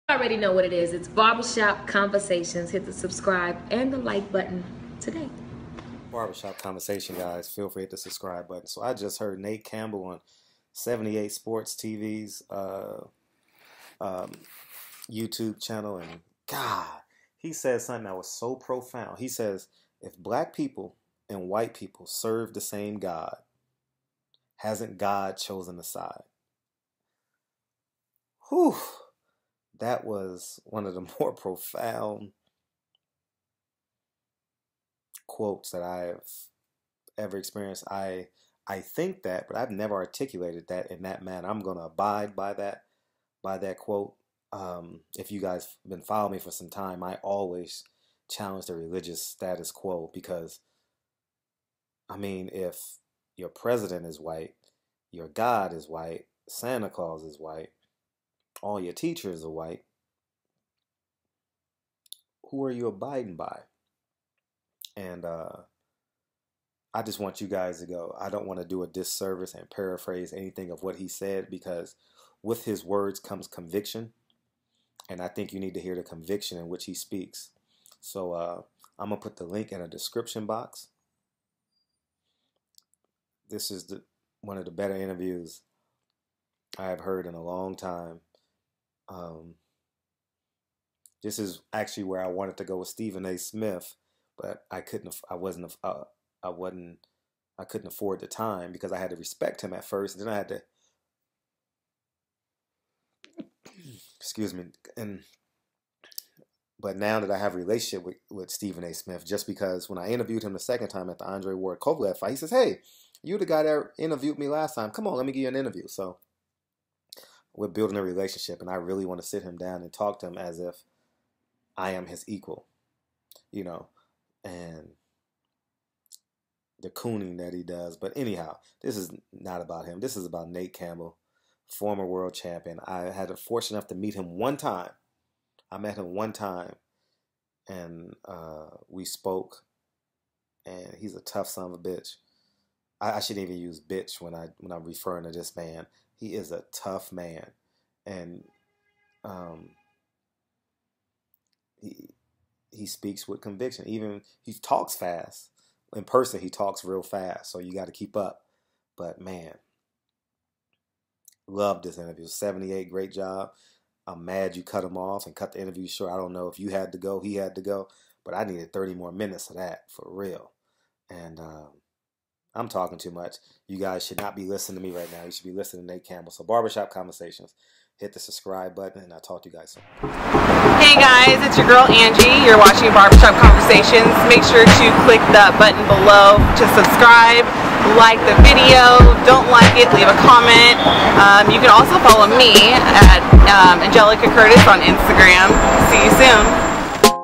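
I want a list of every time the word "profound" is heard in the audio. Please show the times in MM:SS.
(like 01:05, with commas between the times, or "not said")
00:18, 00:31.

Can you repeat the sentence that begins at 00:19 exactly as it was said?
He says, if black people and white people serve the same God, hasn't God chosen a side?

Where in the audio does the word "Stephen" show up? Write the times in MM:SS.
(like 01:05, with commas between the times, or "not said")
01:32, 01:48.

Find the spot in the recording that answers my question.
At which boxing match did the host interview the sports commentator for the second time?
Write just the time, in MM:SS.
01:51.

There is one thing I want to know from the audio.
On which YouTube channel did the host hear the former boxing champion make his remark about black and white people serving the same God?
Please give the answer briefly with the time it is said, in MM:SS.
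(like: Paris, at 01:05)
78 Sports TV, at 00:10.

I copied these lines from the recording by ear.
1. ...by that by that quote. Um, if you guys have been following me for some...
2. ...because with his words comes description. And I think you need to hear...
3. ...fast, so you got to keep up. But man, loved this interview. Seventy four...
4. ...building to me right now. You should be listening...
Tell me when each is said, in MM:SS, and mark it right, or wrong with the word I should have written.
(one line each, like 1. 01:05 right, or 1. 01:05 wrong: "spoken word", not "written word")
1. 00:42 right
2. 01:11 wrong: "conviction", not "description"
3. 02:37 wrong: "eight", not "four"
4. 02:54 wrong: "listening", not "building".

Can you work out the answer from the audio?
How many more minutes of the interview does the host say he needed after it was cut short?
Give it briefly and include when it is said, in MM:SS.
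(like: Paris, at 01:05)
30, at 02:48.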